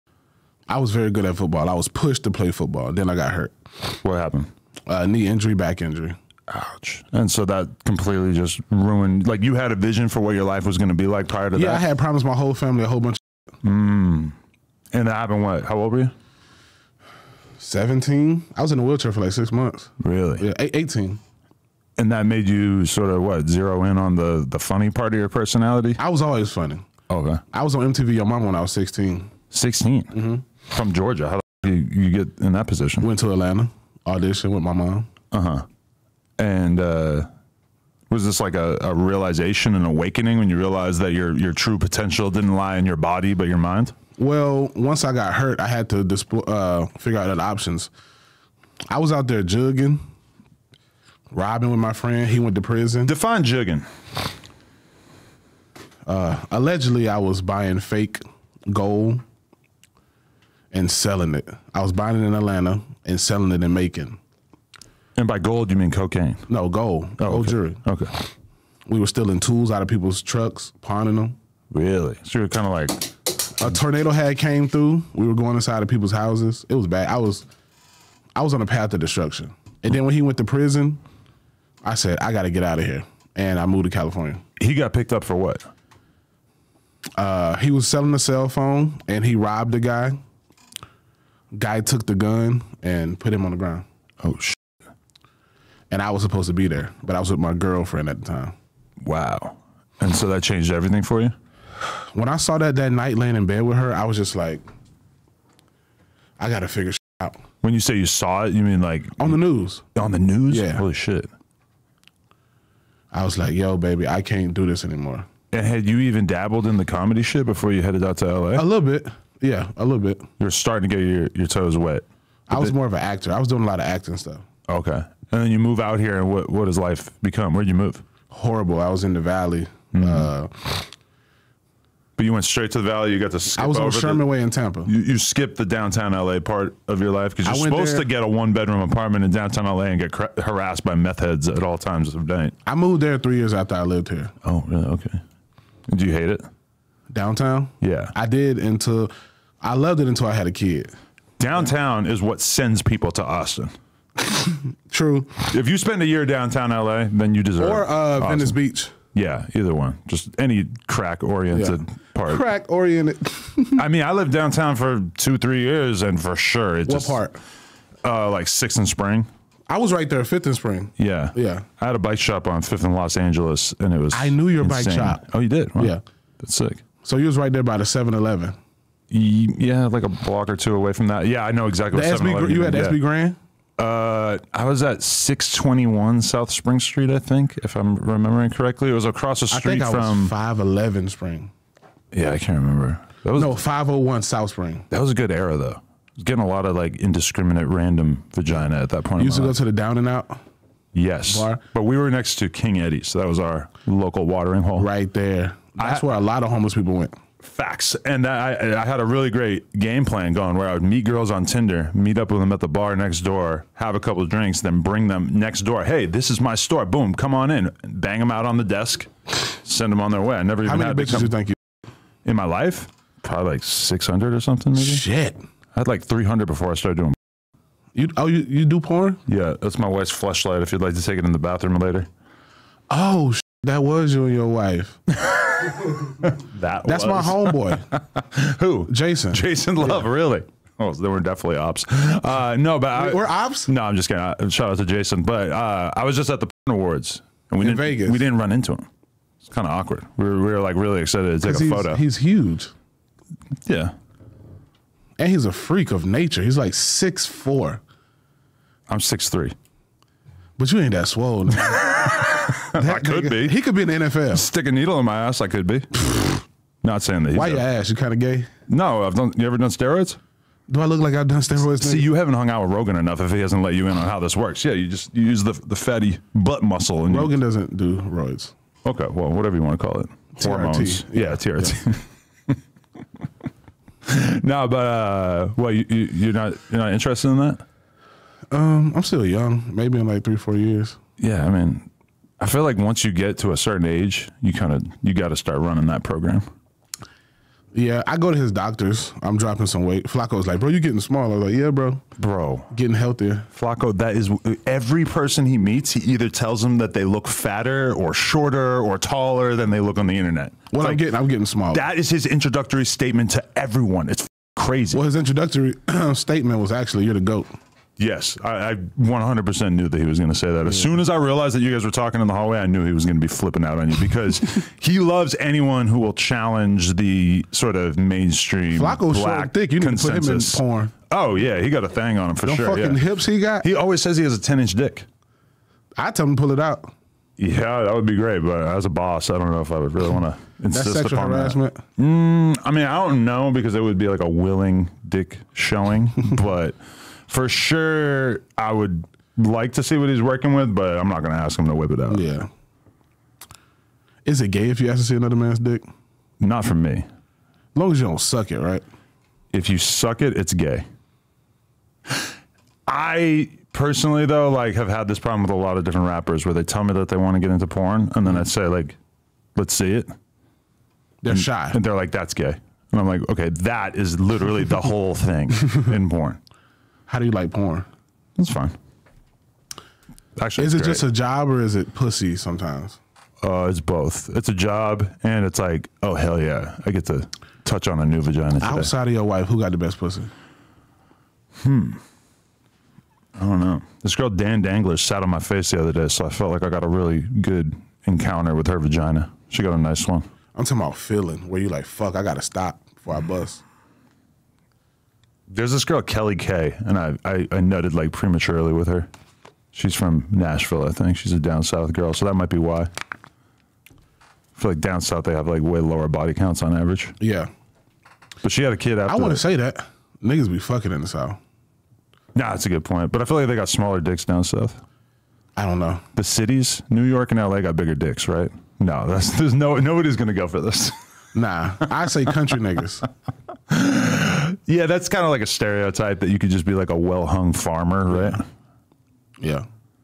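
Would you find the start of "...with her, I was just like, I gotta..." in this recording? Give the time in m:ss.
1:43.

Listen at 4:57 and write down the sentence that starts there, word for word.
Yeah, I go to his doctors.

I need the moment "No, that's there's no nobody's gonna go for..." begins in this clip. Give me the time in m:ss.
7:08.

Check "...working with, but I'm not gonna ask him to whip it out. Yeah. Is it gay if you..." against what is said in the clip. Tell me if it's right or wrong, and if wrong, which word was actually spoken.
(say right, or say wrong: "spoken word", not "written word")
right.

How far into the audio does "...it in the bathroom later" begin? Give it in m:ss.
3:51.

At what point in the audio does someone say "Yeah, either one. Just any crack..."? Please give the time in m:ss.
2:39.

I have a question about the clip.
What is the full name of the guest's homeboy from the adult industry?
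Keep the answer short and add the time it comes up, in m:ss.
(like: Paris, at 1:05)
Jason Love, at 3:59.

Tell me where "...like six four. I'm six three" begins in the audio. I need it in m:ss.
4:16.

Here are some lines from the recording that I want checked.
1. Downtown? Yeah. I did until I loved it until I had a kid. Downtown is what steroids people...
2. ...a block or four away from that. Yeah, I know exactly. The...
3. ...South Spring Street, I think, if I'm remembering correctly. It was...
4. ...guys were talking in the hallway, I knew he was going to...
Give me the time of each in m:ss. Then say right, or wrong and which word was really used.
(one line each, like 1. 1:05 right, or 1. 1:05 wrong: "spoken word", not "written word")
1. 2:27 wrong: "sends", not "steroids"
2. 3:00 wrong: "two", not "four"
3. 3:06 right
4. 5:21 right.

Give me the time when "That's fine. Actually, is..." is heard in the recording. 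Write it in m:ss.
6:18.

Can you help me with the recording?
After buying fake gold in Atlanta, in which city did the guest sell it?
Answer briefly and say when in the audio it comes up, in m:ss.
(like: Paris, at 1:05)
Macon, at 1:03.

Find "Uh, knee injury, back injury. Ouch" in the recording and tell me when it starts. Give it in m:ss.
0:04.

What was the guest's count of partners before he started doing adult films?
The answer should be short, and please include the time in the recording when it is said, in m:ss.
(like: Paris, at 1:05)
300, at 3:46.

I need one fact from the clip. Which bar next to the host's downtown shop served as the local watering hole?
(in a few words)
King Eddy.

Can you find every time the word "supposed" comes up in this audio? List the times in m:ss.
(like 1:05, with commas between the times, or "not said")
1:36, 2:17.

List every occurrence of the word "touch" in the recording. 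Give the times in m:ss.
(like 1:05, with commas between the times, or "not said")
6:27.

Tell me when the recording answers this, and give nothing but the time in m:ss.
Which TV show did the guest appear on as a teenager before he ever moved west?
0:27.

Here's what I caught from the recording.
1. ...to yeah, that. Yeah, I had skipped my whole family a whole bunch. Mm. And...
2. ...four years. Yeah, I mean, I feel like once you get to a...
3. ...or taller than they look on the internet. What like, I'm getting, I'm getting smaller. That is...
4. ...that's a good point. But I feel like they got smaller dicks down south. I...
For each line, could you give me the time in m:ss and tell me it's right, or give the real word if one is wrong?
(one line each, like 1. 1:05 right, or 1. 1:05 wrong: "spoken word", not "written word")
1. 0:11 wrong: "promised", not "skipped"
2. 4:50 right
3. 5:08 right
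4. 7:02 right.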